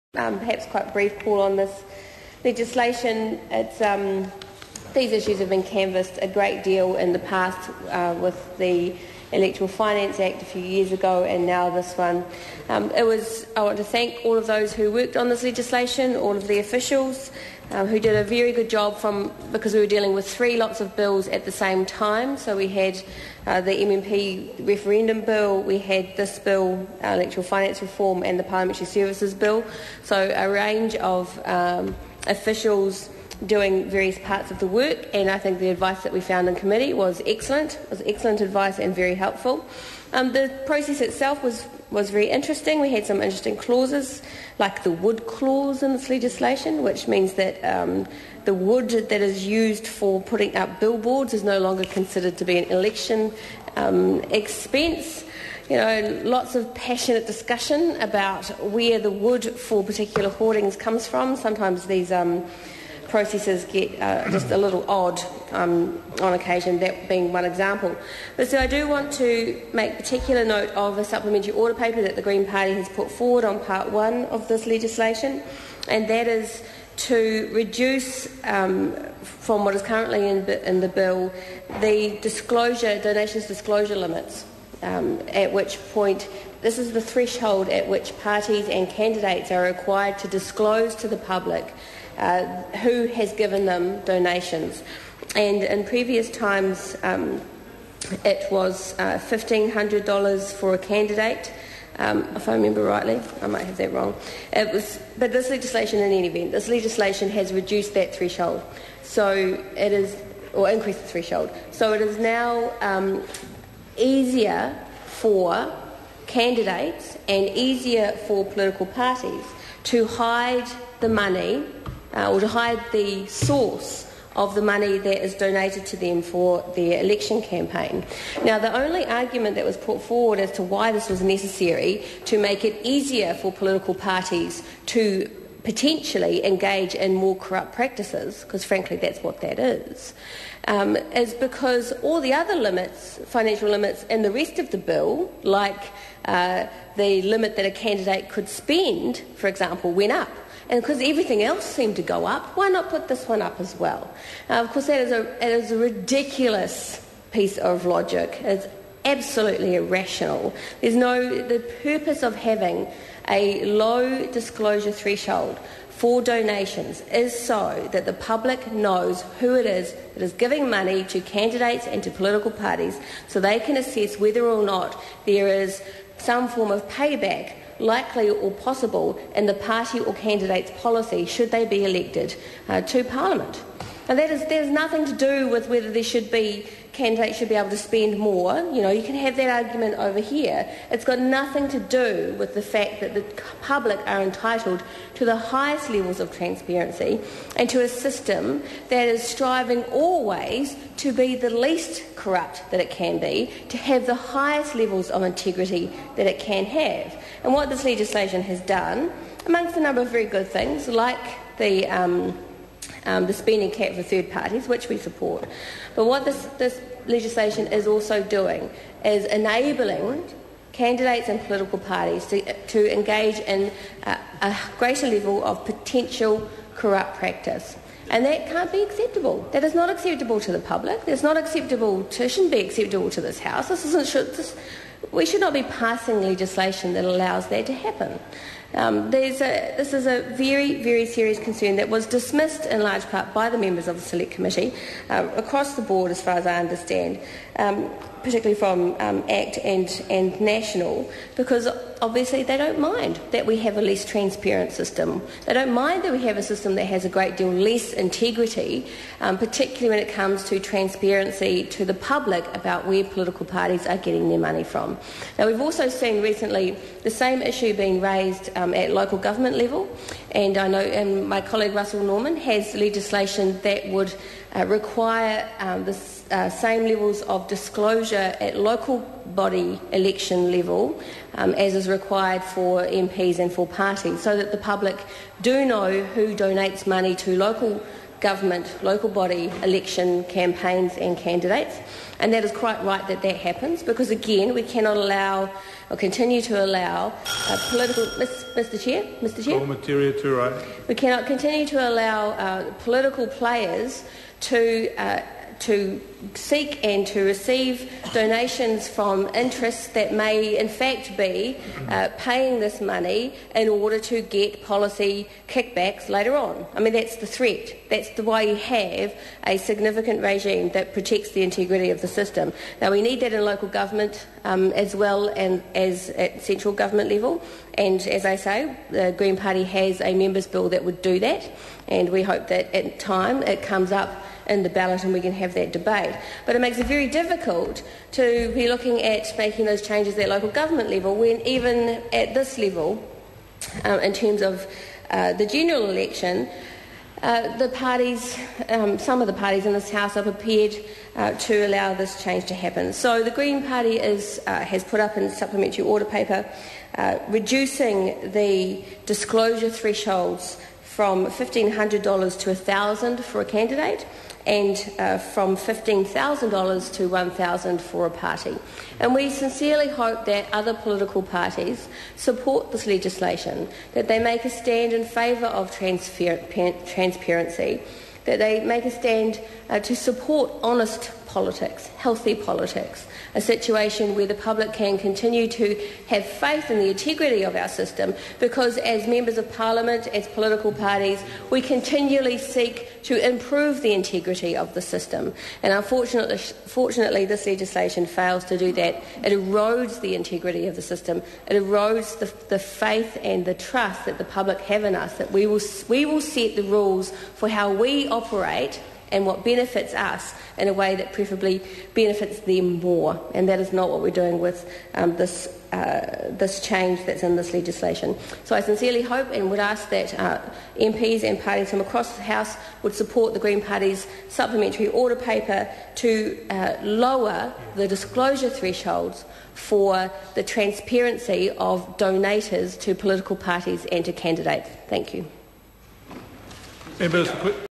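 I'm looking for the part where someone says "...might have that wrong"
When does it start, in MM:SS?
01:43.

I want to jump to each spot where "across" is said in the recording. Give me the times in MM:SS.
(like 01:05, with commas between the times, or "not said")
04:05, 07:01.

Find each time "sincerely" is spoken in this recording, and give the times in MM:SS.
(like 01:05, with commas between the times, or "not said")
06:09, 06:58.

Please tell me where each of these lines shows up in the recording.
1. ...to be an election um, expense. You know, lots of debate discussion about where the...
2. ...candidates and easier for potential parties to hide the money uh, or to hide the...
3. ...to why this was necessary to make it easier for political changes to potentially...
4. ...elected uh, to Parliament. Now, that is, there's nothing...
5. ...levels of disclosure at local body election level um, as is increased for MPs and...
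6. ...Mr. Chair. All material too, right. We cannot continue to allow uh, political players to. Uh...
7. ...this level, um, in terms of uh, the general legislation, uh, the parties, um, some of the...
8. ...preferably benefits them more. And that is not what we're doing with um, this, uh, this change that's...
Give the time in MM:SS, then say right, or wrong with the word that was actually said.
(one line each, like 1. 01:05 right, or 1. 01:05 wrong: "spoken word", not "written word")
1. 00:52 wrong: "passionate", not "debate"
2. 01:56 wrong: "political", not "potential"
3. 02:10 wrong: "parties", not "changes"
4. 03:01 right
5. 04:36 wrong: "required", not "increased"
6. 04:59 right
7. 05:42 wrong: "election", not "legislation"
8. 06:51 right.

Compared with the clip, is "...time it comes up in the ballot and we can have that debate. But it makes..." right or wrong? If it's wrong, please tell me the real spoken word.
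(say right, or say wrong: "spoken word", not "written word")
right.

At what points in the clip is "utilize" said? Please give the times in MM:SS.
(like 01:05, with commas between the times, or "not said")
not said.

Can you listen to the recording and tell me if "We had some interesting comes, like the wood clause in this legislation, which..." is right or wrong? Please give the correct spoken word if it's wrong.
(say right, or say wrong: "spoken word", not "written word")
wrong: "clauses", not "comes".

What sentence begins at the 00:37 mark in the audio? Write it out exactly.
It was excellent advice and very helpful.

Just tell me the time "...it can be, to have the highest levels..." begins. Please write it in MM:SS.
03:22.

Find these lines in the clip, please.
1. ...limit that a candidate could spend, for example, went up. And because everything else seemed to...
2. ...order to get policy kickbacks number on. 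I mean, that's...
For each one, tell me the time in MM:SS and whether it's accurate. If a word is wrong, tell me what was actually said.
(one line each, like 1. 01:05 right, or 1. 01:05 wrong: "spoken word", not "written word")
1. 02:27 right
2. 05:13 wrong: "later", not "number".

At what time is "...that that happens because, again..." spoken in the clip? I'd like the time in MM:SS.
04:53.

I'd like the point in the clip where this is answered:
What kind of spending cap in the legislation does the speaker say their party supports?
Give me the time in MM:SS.
03:33.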